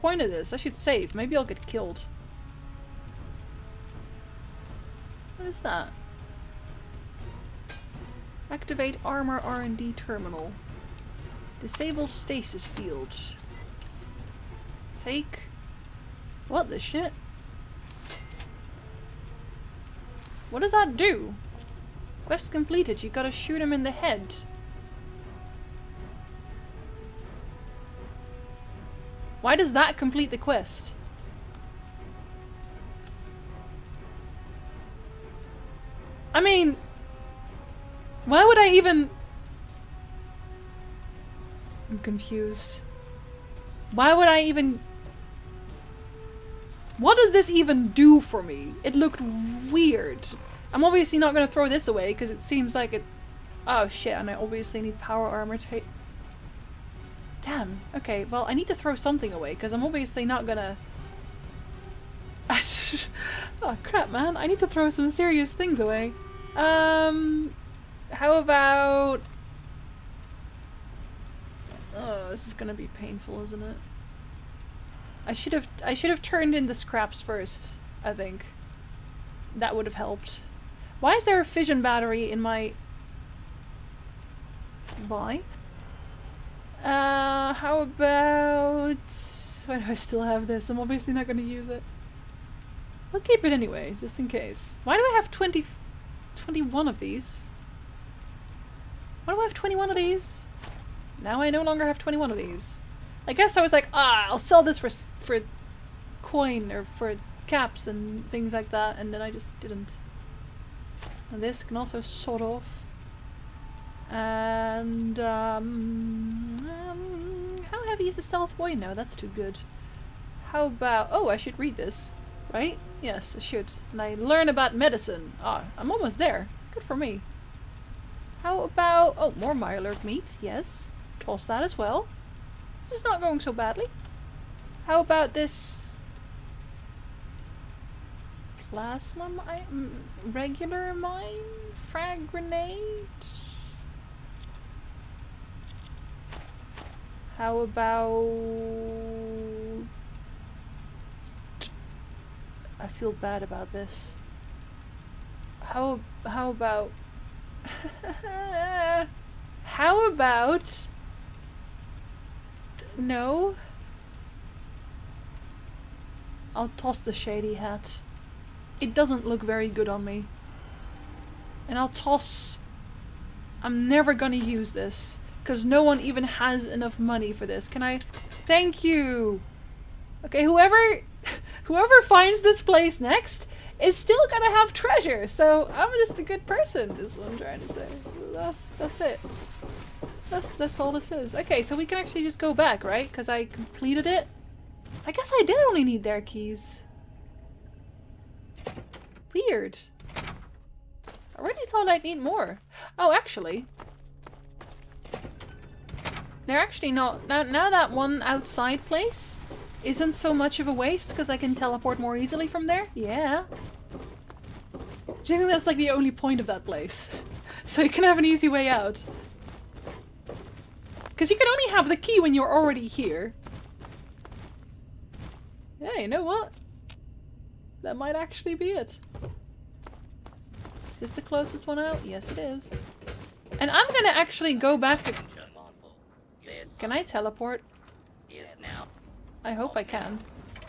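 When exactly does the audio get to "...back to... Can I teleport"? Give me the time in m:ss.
3:54.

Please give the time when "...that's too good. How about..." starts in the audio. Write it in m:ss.
1:58.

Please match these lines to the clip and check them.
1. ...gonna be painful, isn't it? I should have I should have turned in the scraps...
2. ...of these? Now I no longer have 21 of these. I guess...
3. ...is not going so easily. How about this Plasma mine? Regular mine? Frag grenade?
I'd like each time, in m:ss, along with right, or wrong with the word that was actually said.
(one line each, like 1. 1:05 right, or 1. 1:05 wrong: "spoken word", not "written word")
1. 1:12 right
2. 1:39 right
3. 2:12 wrong: "badly", not "easily".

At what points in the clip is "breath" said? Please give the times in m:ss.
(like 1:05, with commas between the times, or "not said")
not said.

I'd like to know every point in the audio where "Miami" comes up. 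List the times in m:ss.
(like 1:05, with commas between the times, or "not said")
not said.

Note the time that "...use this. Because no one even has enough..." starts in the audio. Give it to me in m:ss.
2:54.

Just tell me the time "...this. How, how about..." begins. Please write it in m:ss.
2:33.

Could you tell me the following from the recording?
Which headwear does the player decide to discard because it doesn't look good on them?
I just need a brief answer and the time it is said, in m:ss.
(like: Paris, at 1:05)
shady hat, at 2:47.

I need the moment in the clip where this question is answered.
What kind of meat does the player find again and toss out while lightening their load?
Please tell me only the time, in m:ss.
2:09.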